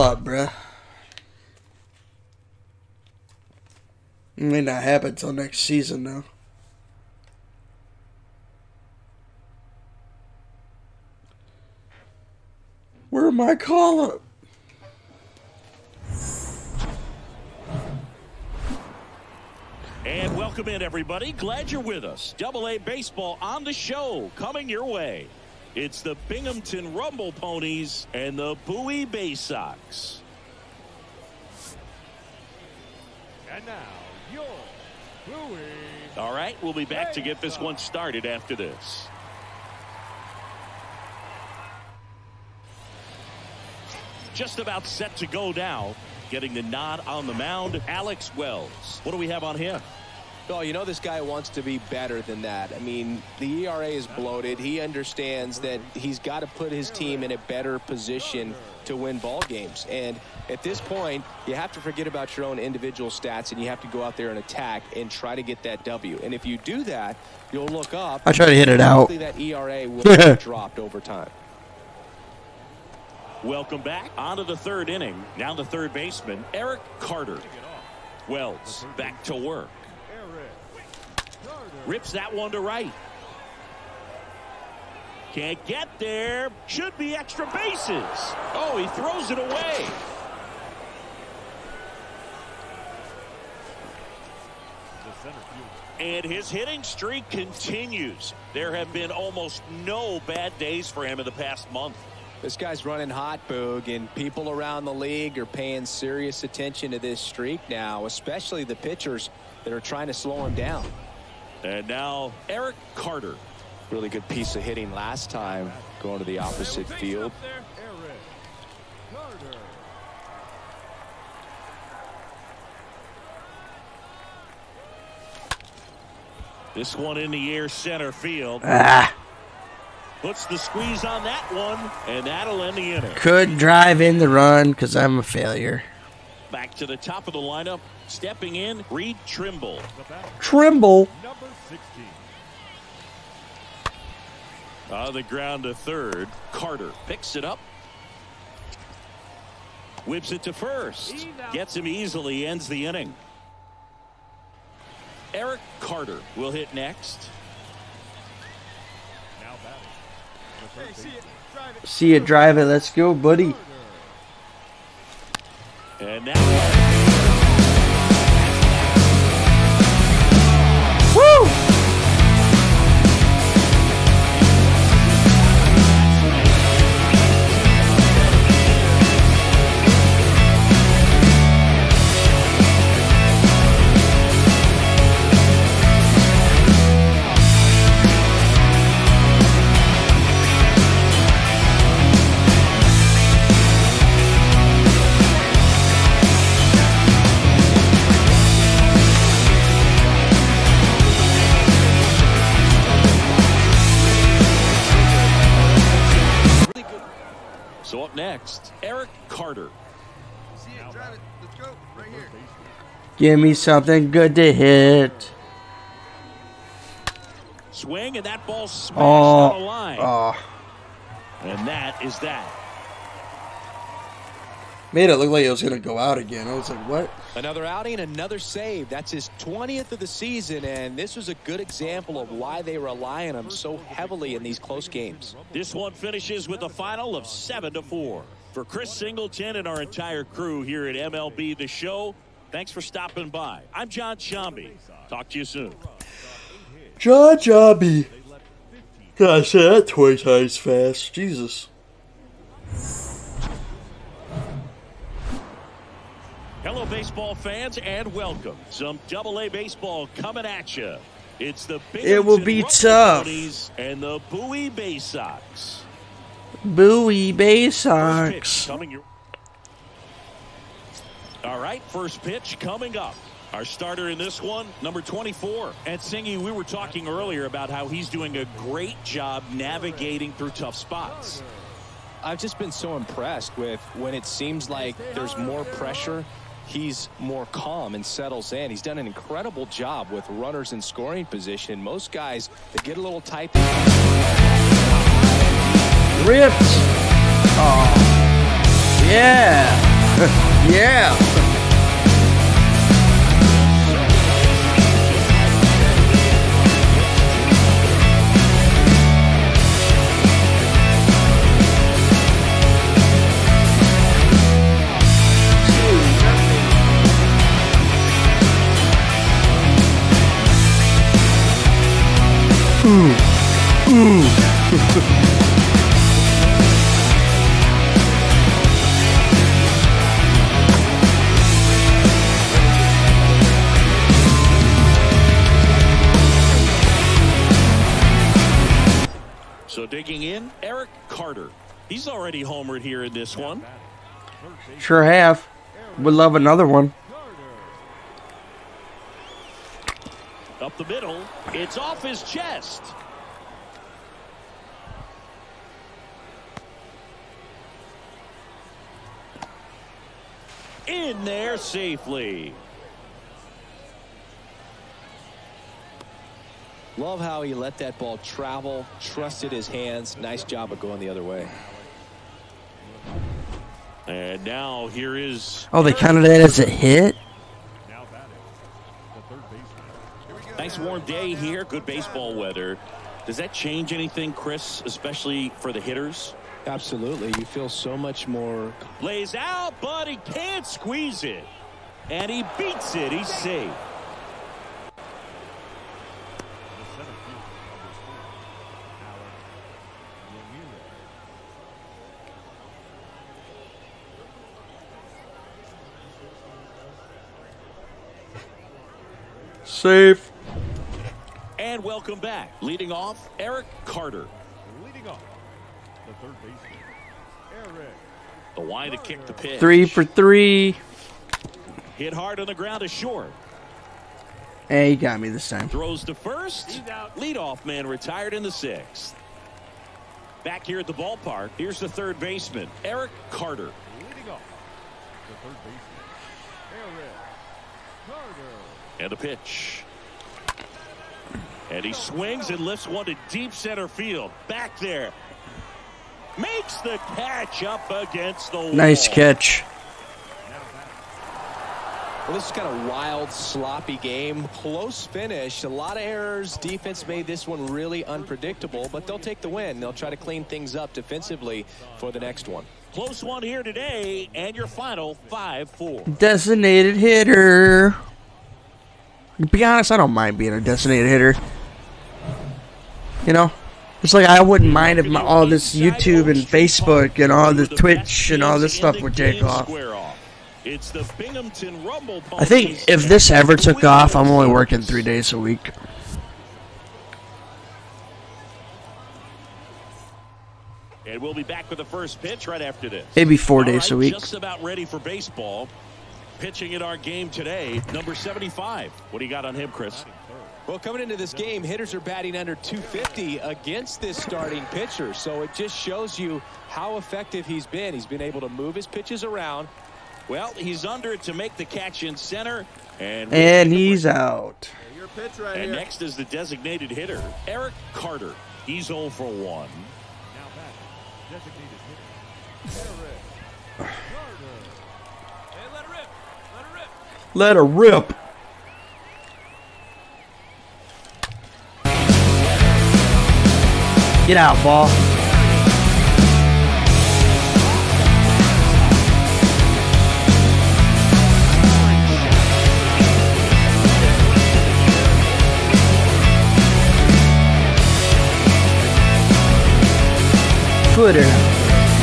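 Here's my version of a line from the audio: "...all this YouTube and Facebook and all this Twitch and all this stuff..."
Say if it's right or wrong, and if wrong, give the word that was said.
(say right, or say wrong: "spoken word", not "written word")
right.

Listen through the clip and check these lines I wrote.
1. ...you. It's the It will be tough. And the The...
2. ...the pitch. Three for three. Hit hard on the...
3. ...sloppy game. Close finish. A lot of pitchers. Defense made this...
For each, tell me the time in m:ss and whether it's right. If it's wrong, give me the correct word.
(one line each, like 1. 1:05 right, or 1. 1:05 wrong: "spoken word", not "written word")
1. 4:20 wrong: "Bowie", not "The"
2. 6:59 right
3. 7:33 wrong: "errors", not "pitchers".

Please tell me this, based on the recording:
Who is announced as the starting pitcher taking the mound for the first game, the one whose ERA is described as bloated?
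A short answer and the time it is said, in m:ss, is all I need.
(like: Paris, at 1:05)
Alex Wells, at 0:47.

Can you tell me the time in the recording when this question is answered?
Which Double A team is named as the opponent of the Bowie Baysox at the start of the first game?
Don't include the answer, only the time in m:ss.
0:26.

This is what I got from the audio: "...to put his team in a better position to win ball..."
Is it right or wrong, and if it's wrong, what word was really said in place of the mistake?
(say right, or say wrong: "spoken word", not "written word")
right.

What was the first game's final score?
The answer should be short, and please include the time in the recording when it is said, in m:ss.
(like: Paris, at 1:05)
7 to 4, at 3:57.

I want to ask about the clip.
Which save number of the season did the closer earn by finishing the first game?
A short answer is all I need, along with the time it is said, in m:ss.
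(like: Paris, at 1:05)
20, at 3:49.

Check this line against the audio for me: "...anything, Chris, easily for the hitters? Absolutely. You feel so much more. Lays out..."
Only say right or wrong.
wrong.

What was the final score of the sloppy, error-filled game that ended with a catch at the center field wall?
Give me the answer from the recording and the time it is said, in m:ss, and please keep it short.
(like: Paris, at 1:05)
5-4, at 7:45.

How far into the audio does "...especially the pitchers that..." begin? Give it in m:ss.
1:48.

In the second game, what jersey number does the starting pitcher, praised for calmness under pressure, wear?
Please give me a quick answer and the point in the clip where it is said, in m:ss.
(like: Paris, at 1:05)
24, at 4:34.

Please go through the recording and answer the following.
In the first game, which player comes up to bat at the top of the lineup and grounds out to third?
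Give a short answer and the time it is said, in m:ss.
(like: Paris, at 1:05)
Reed Trimble, at 2:18.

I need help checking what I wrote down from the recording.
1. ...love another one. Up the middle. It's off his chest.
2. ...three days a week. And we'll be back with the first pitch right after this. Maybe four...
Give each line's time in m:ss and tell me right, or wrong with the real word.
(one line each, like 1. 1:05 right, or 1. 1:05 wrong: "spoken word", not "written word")
1. 5:46 right
2. 8:04 right.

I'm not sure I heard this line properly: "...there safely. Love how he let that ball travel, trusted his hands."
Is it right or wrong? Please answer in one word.
right.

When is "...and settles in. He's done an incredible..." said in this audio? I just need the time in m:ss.
4:47.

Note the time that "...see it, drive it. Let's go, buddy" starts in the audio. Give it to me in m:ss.
2:41.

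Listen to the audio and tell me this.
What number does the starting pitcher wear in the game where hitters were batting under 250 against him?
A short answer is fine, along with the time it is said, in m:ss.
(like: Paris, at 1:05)
75, at 8:17.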